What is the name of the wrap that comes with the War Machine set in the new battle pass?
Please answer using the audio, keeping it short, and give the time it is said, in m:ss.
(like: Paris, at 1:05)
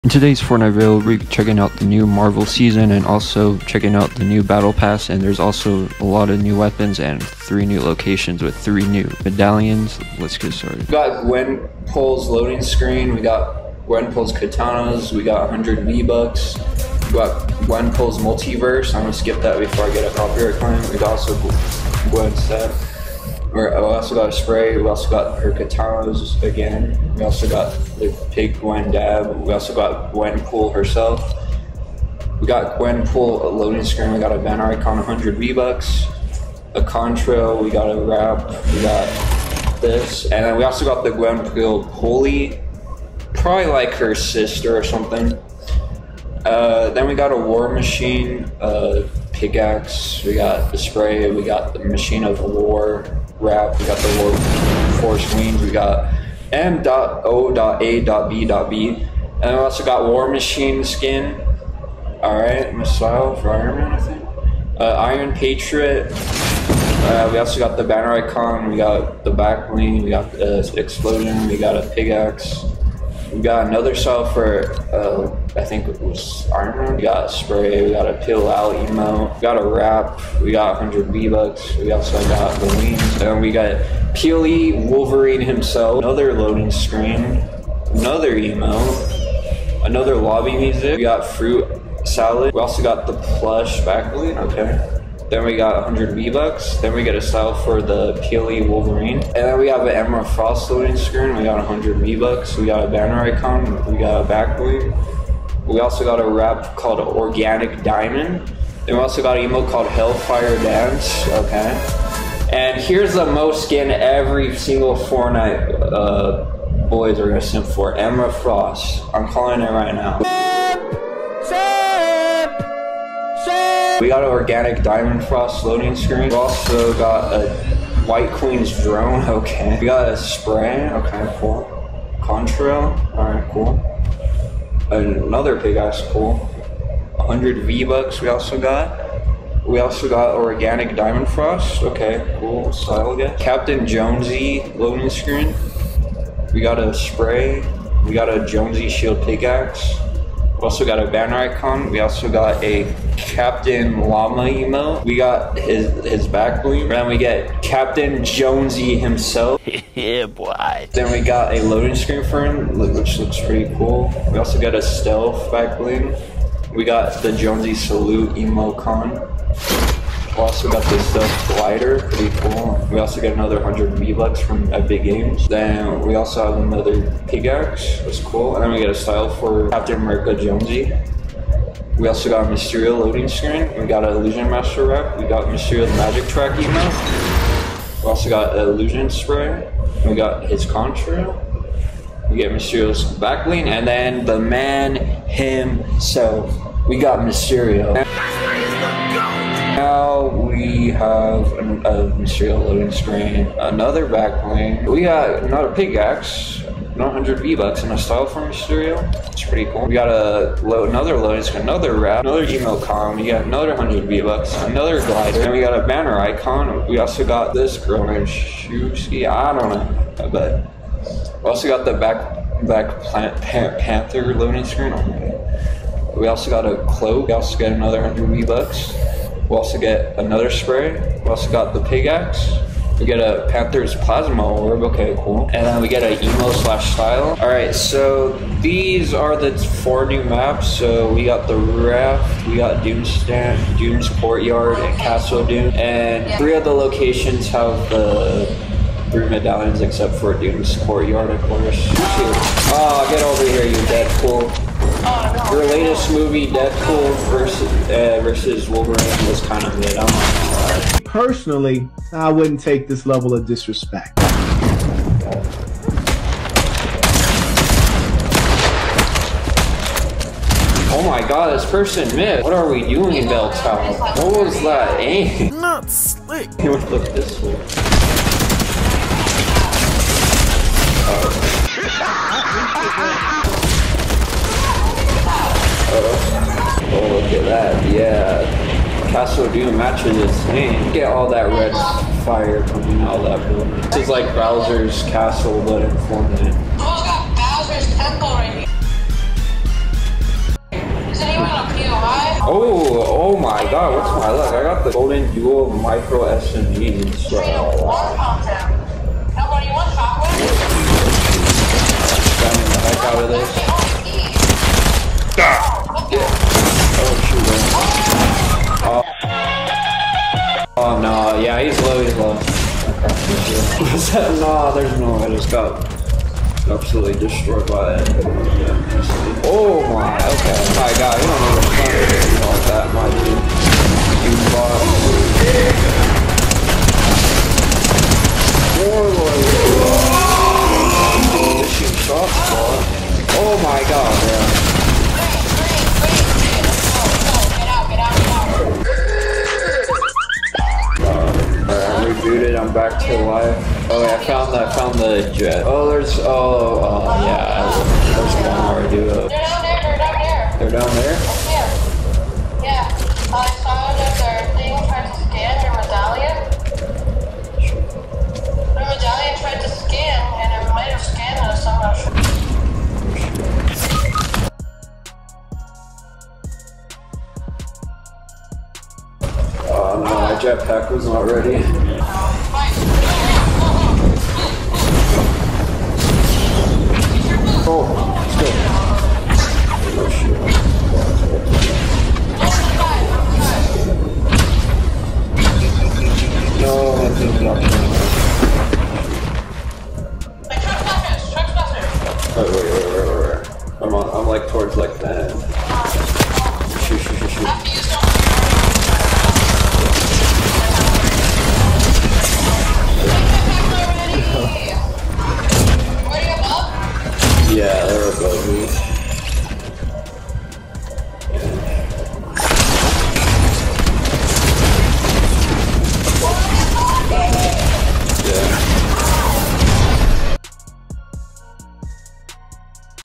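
Machine of War, at 0:51.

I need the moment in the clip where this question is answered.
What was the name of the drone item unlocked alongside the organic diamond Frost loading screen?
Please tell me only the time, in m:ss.
2:08.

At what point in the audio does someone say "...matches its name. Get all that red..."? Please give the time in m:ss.
4:49.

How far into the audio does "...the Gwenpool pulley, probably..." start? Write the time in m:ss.
0:41.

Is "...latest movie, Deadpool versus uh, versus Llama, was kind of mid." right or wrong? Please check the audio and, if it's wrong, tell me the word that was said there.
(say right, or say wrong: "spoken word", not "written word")
wrong: "Wolverine", not "Llama".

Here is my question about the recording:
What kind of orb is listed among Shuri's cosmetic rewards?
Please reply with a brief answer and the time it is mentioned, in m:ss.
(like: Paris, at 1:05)
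Panther's Plasma Orb, at 3:53.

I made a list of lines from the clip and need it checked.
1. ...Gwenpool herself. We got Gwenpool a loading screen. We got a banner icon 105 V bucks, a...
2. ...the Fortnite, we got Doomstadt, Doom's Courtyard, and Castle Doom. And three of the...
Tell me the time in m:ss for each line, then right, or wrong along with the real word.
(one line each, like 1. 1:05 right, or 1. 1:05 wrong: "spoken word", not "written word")
1. 0:30 wrong: "100", not "105"
2. 4:01 wrong: "Raft", not "Fortnite".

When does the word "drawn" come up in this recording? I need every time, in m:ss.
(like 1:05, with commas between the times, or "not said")
not said.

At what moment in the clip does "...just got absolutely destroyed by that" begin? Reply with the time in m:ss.
5:25.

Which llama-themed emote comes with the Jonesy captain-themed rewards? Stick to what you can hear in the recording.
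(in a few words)
Captain Llama.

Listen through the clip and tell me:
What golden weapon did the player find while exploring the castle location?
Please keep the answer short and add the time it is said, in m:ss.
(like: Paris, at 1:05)
Golden Dual Micro SMG, at 5:04.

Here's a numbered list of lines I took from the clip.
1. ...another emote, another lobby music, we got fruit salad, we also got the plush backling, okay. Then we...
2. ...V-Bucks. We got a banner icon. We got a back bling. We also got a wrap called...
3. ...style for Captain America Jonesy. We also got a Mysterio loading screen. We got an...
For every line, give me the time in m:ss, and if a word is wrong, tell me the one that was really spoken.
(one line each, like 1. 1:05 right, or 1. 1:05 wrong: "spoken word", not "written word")
1. 1:27 right
2. 1:41 right
3. 2:58 right.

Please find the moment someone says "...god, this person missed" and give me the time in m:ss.
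4:31.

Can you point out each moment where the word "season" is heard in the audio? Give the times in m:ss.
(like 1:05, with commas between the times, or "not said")
0:02.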